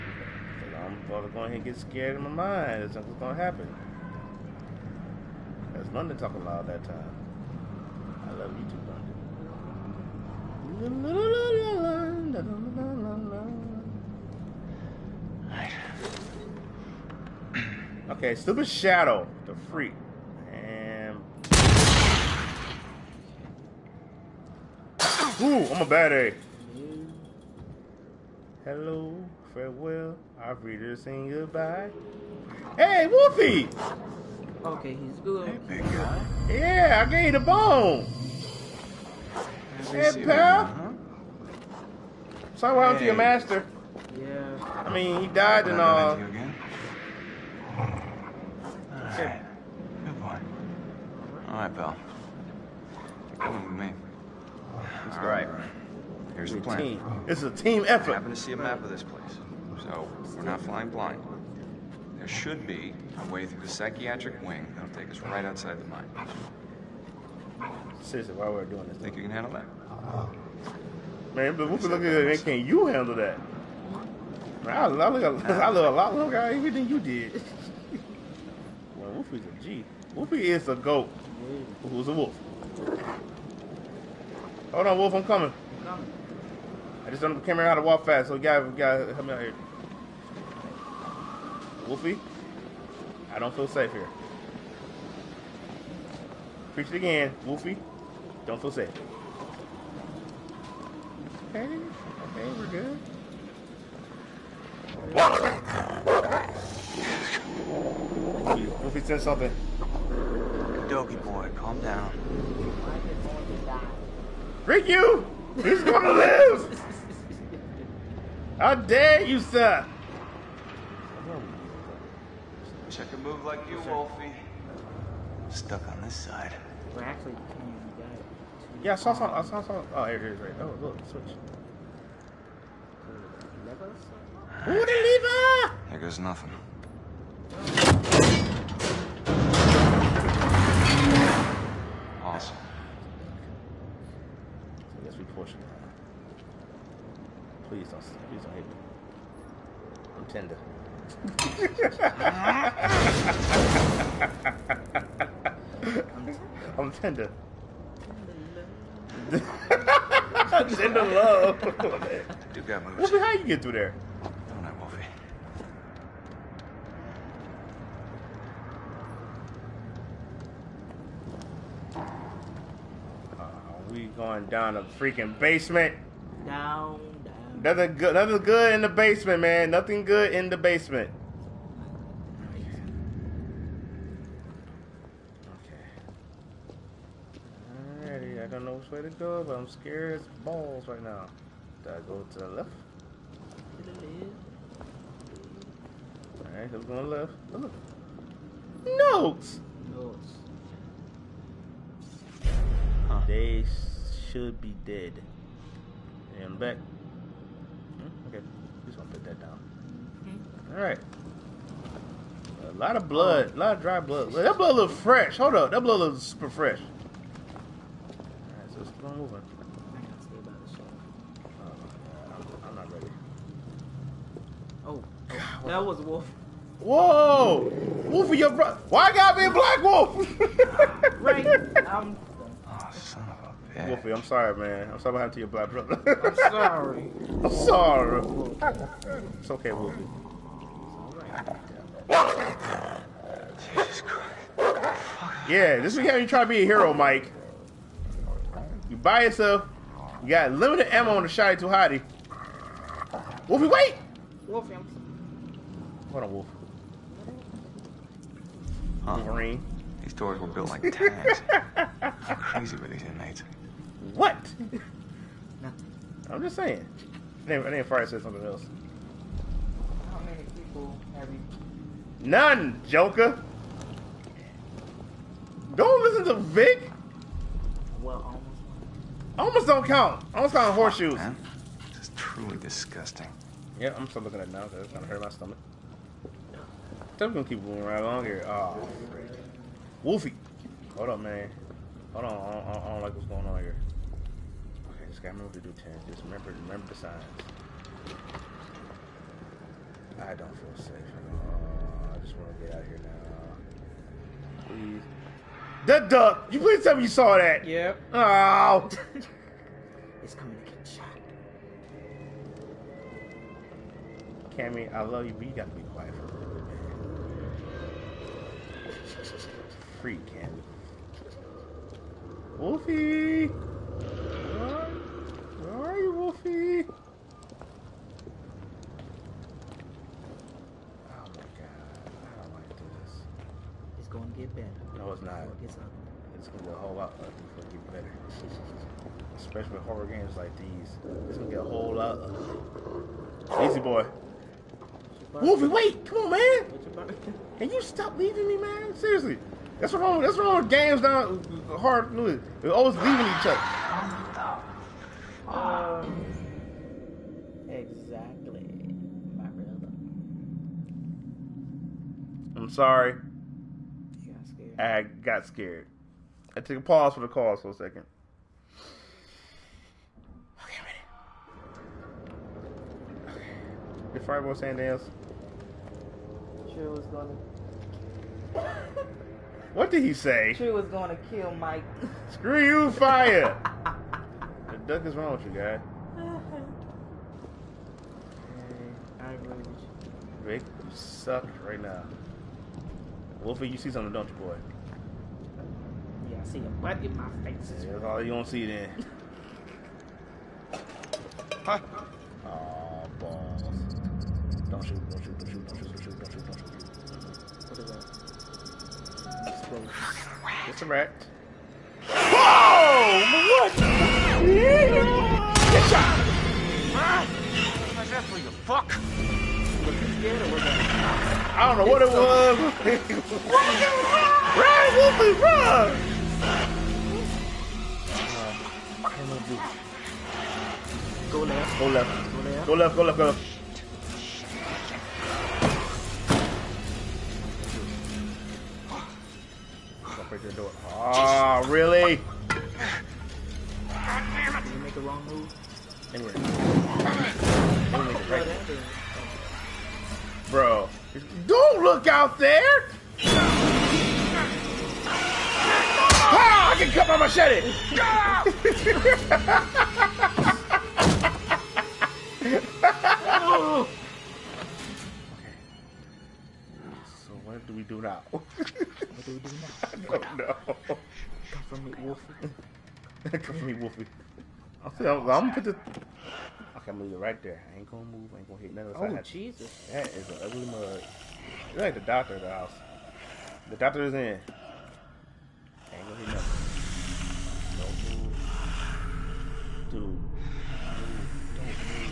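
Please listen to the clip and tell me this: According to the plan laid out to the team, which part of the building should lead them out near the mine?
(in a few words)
psychiatric wing.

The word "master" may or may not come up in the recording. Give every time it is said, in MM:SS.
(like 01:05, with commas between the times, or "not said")
00:43.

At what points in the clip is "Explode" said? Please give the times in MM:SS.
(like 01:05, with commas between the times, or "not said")
06:49.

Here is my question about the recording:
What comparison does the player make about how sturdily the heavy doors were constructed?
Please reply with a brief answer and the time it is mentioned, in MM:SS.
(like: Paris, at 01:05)
like tanks, at 04:20.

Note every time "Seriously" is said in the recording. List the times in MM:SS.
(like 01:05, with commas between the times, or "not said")
01:08, 05:48.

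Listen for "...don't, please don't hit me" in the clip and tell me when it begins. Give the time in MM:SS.
02:27.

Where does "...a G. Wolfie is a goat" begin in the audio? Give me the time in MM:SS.
01:19.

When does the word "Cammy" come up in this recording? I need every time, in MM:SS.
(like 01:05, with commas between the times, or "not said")
05:14, 05:20.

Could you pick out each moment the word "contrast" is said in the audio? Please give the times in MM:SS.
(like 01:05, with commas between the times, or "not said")
not said.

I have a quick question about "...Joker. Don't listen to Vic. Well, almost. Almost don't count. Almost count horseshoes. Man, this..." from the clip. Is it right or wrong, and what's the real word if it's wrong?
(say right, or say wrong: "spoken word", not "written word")
right.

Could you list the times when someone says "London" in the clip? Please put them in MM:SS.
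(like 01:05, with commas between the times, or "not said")
00:05, 00:18.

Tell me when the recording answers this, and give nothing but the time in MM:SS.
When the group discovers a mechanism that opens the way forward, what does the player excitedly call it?
02:14.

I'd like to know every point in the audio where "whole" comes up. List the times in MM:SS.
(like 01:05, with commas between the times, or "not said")
05:36, 05:41.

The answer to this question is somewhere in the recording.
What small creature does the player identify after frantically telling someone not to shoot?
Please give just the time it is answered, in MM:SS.
06:50.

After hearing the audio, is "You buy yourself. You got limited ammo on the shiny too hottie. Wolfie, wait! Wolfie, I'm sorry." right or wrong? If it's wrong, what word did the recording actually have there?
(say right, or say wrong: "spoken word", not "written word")
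right.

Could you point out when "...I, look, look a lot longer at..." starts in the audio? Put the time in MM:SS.
01:14.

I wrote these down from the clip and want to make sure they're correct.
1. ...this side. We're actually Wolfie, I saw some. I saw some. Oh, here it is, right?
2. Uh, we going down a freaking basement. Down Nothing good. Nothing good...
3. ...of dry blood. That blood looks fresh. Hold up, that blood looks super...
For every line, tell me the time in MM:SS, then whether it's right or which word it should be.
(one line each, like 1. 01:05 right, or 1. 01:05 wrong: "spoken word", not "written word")
1. 02:05 wrong: "Yeah", not "Wolfie"
2. 02:53 right
3. 03:33 right.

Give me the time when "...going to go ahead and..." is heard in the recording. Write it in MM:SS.
00:01.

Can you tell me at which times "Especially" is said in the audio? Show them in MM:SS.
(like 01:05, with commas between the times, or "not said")
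05:39.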